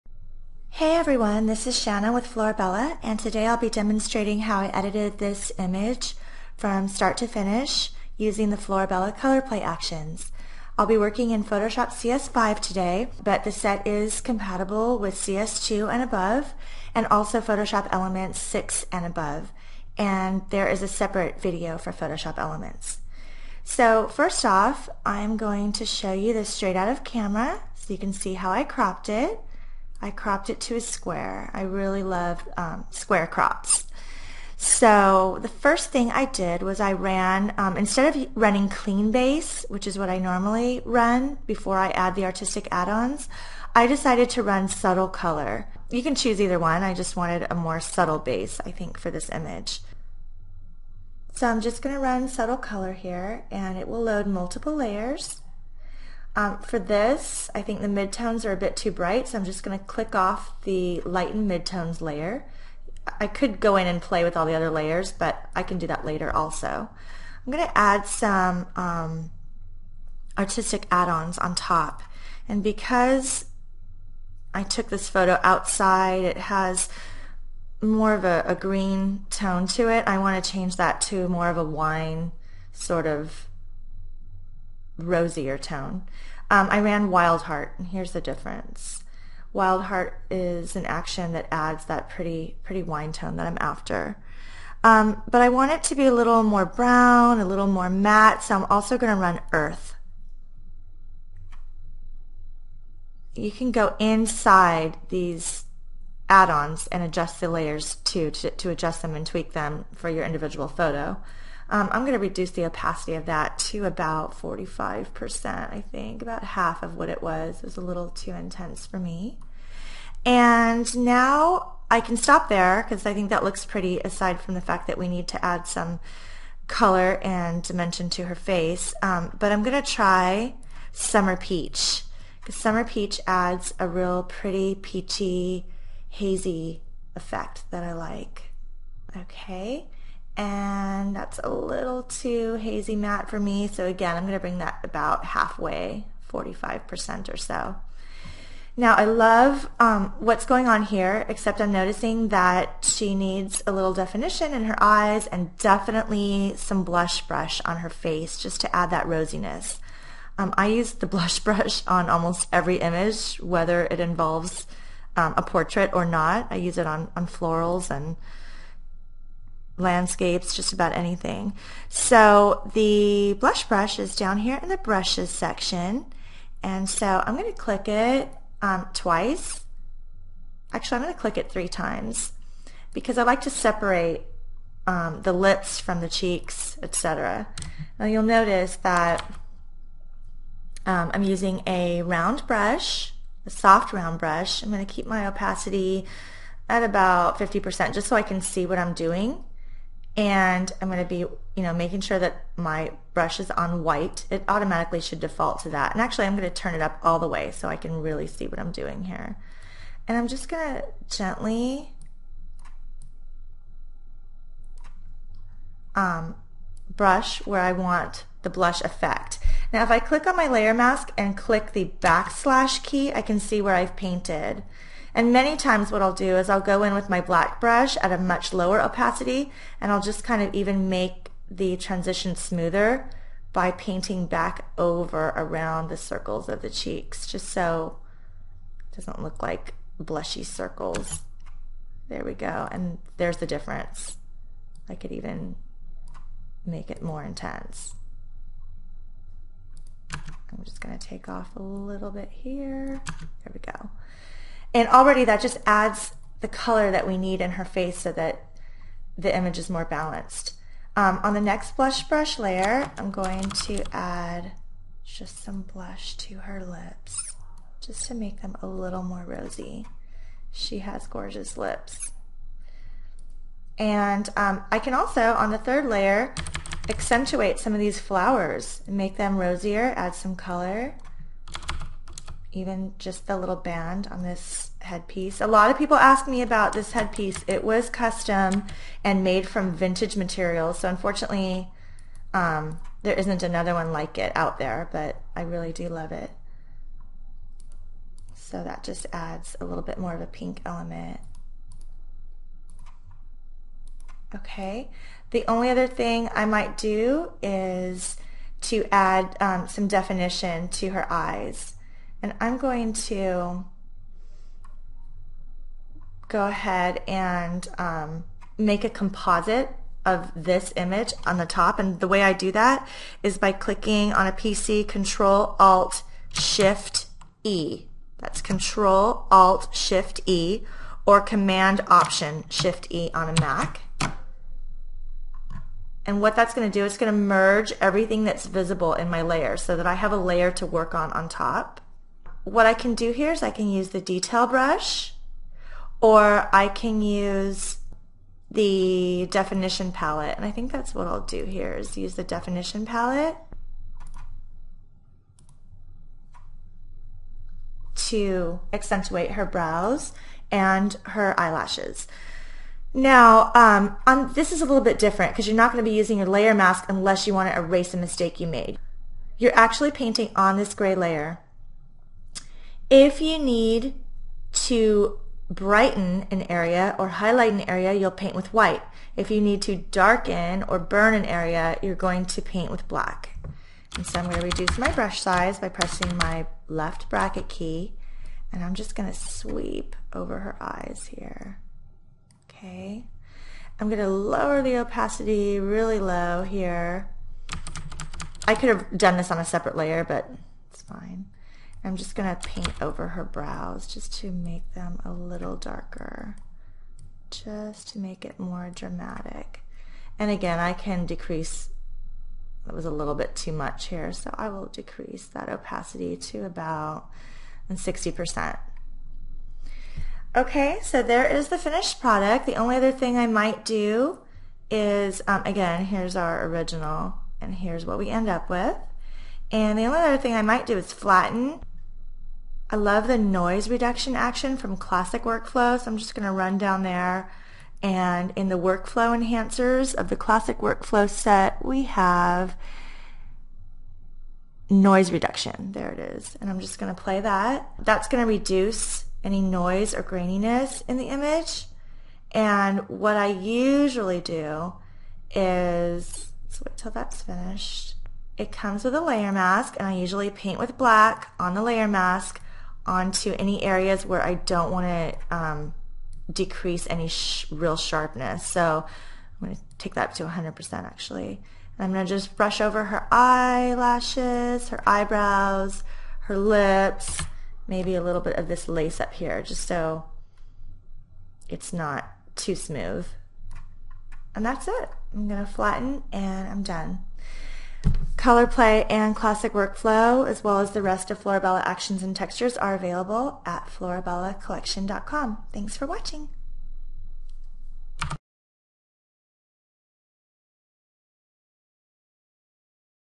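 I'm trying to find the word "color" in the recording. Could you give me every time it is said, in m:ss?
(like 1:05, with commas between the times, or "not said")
0:09, 0:45, 0:52, 2:06, 4:16, 4:40, 8:08.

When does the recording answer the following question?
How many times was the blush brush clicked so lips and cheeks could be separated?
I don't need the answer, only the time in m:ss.
3:01.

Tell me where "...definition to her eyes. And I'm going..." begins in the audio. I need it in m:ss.
5:09.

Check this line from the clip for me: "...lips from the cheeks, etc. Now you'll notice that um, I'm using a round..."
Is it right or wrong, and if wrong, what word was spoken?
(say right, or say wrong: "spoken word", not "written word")
right.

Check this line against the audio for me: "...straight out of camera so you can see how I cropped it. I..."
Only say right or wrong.
right.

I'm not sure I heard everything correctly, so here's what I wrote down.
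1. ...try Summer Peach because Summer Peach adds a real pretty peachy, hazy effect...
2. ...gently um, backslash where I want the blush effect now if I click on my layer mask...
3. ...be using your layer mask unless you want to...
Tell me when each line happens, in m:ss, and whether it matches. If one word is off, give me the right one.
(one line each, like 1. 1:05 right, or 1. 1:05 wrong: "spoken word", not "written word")
1. 2:09 right
2. 3:31 wrong: "brush", not "backslash"
3. 6:05 right.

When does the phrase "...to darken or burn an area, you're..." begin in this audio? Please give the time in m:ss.
6:19.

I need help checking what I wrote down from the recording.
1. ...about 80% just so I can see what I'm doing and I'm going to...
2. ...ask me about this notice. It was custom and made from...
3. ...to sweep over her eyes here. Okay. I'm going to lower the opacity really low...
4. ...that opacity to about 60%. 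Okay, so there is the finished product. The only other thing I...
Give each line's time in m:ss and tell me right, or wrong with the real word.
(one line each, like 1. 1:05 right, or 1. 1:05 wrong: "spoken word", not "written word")
1. 3:16 wrong: "50", not "80"
2. 4:45 wrong: "headpiece", not "notice"
3. 6:29 right
4. 6:55 right.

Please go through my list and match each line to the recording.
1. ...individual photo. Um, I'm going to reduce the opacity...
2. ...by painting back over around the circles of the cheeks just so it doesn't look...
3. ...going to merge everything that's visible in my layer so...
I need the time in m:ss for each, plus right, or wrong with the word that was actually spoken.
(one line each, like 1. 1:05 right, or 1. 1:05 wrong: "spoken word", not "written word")
1. 1:50 right
2. 3:53 right
3. 5:36 right.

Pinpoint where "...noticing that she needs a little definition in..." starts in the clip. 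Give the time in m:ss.
2:31.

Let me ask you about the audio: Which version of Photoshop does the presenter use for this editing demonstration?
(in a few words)
Photoshop CS5.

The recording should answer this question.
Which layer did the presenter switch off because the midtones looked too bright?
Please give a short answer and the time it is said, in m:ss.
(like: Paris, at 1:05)
Lighten midtones, at 1:01.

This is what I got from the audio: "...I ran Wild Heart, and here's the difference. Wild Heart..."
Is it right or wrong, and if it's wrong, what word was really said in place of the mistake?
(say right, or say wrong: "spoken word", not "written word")
right.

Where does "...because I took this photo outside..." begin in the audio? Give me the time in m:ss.
1:12.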